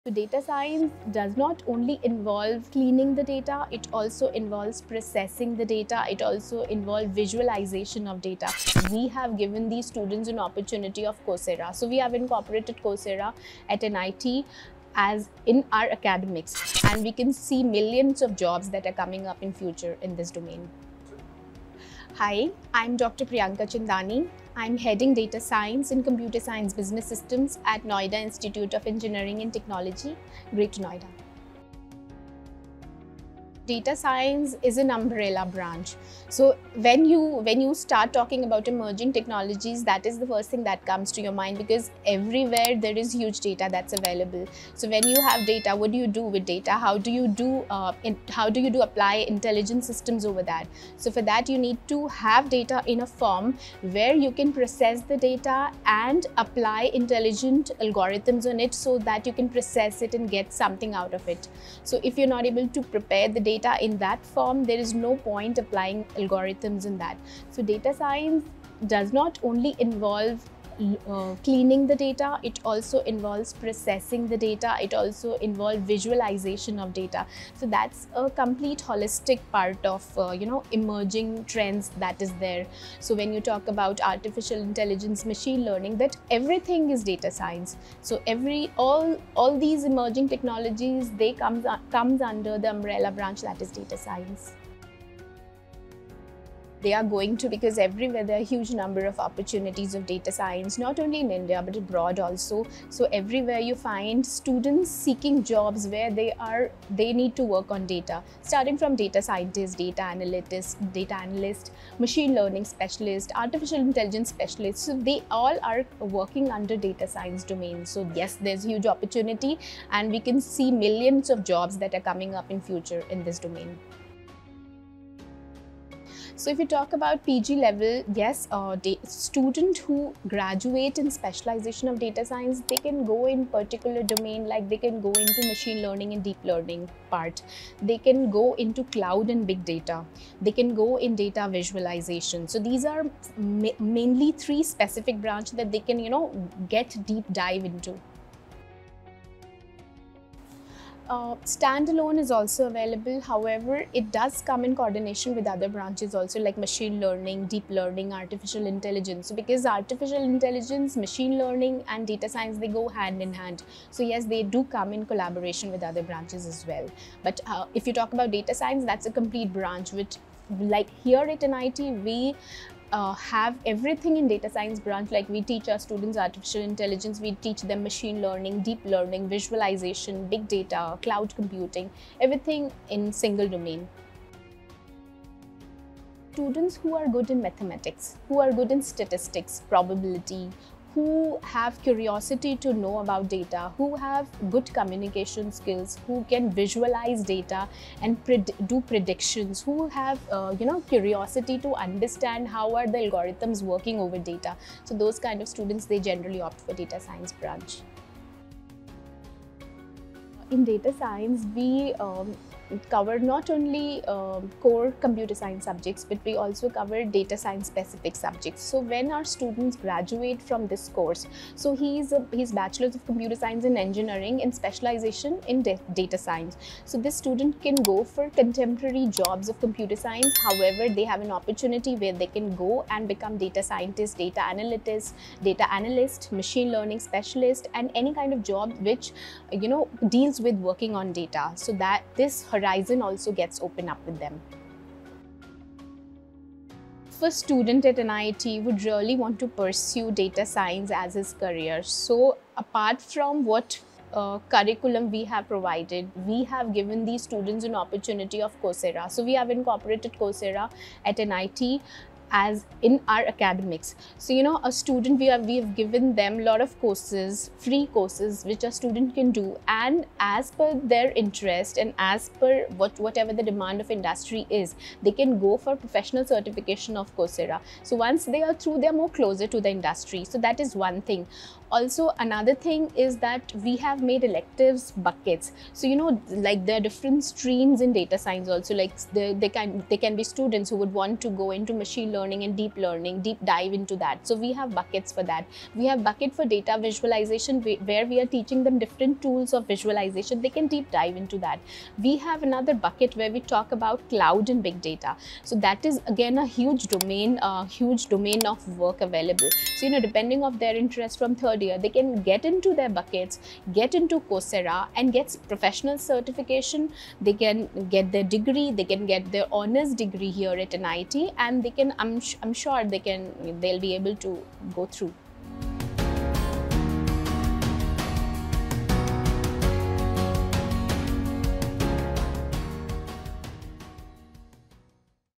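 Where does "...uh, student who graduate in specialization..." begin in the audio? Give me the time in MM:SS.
02:08.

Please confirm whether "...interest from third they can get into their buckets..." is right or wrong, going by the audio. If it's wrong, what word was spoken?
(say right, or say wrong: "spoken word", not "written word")
right.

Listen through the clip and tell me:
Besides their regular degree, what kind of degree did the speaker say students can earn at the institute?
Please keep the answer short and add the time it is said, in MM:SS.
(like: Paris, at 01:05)
honors degree, at 05:19.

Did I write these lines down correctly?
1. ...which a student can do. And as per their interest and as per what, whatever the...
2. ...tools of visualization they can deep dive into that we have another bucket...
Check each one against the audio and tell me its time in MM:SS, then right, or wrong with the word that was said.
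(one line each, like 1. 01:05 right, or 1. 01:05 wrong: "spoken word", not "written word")
1. 04:28 right
2. 04:59 right.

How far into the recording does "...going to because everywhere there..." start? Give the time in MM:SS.
01:37.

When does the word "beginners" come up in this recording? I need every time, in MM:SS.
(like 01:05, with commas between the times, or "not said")
not said.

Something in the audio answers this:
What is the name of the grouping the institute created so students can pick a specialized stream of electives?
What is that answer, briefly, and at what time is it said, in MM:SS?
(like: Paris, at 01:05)
electives buckets, at 04:44.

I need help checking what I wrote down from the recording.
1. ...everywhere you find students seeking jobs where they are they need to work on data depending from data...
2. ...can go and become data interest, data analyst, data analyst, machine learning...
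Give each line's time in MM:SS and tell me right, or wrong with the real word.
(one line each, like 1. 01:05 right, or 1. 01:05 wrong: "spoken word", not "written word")
1. 01:43 wrong: "starting", not "depending"
2. 03:52 wrong: "scientist", not "interest".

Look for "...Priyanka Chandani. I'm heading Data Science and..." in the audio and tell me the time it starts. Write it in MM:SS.
00:23.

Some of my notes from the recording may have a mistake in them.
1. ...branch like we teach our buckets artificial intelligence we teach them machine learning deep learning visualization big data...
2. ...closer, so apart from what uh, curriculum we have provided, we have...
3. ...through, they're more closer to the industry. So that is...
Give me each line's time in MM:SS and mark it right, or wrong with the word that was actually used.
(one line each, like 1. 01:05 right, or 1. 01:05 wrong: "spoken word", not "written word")
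1. 02:54 wrong: "students", not "buckets"
2. 04:11 wrong: "career", not "closer"
3. 04:38 right.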